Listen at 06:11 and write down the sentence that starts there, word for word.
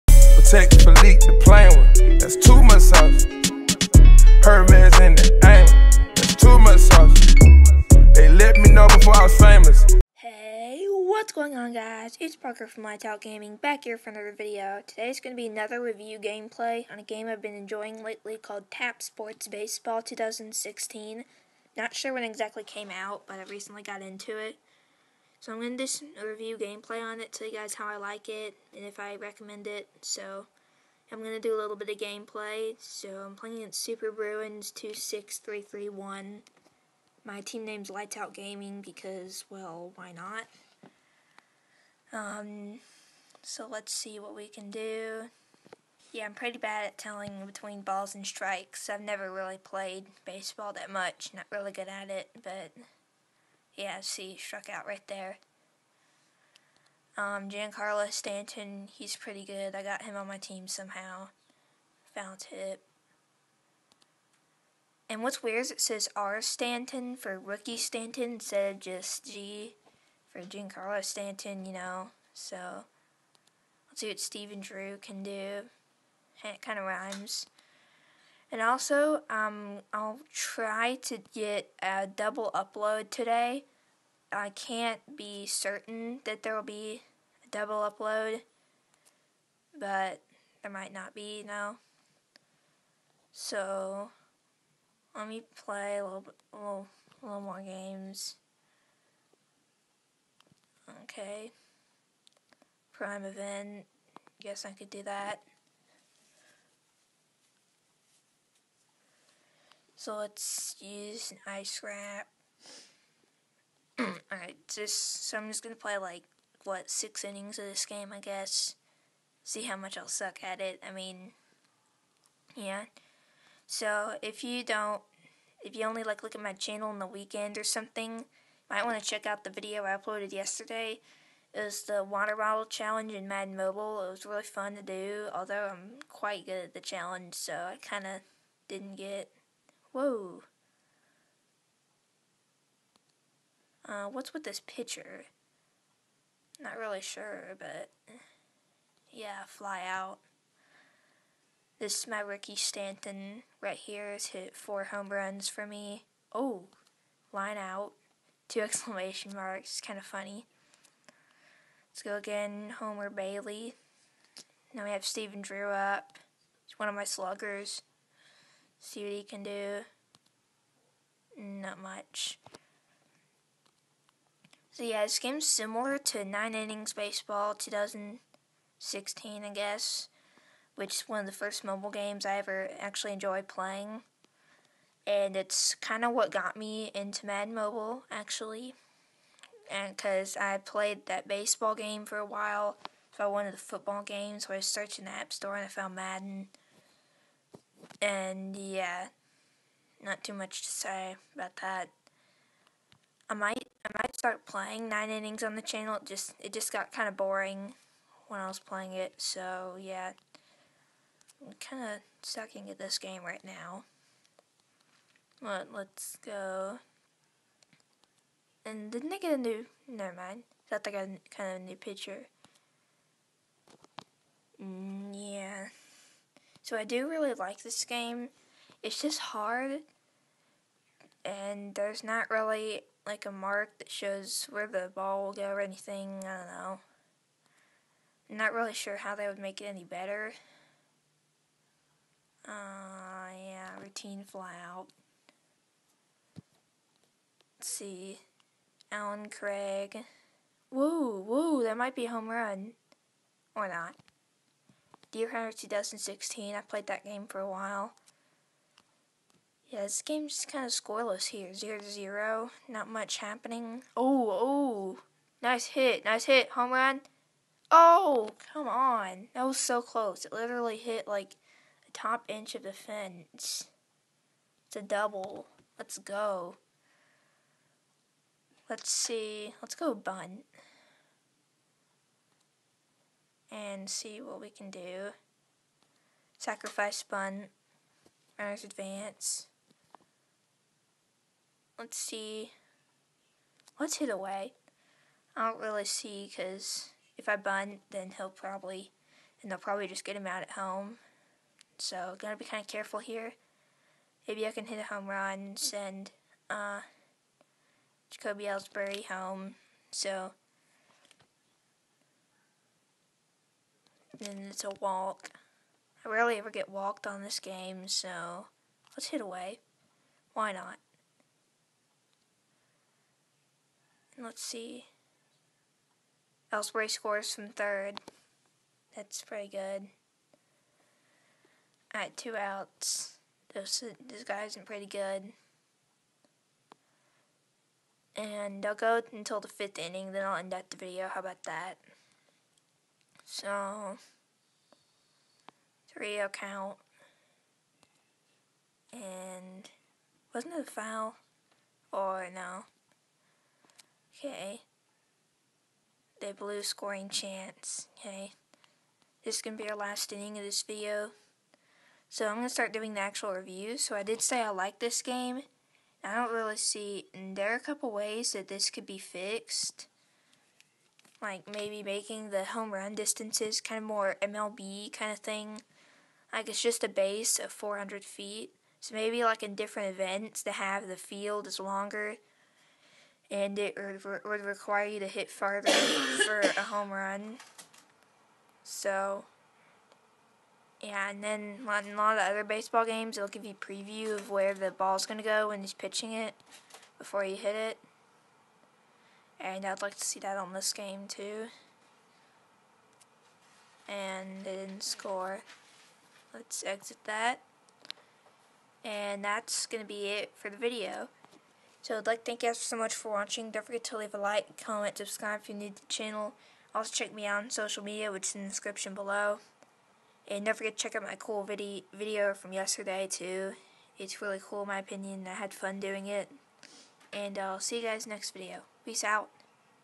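Like maybe making the home run distances kind of more MLB kind of thing.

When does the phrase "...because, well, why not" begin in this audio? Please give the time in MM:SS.
00:38.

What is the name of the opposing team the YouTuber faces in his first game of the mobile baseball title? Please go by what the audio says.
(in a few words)
Super Bruins 26331.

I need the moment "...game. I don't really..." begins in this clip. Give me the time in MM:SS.
06:05.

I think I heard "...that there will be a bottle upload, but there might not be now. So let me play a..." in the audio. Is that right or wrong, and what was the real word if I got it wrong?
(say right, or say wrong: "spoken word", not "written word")
wrong: "double", not "bottle".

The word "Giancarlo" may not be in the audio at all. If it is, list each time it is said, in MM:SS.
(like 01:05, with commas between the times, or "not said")
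00:57, 01:10.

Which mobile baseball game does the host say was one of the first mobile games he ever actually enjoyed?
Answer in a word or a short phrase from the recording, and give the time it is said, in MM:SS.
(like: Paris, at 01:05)
Nine Innings Baseball 2016, at 02:56.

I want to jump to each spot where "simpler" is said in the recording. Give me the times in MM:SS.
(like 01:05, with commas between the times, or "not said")
not said.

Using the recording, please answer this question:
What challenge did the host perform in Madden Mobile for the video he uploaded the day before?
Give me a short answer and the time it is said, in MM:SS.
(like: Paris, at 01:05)
water bottle challenge, at 02:12.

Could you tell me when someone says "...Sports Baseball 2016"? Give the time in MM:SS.
00:19.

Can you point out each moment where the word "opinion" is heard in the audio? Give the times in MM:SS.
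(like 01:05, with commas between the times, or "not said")
07:04.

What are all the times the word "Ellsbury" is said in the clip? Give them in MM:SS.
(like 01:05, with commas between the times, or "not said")
05:08, 05:26.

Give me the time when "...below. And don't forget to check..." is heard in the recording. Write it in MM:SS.
06:58.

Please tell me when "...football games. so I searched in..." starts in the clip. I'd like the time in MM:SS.
03:13.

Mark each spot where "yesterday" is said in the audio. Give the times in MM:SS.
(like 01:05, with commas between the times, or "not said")
02:10, 07:02.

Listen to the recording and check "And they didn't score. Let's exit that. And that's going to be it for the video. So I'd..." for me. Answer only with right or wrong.
right.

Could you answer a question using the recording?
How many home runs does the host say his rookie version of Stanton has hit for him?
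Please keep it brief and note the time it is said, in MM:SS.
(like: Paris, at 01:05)
4, at 02:34.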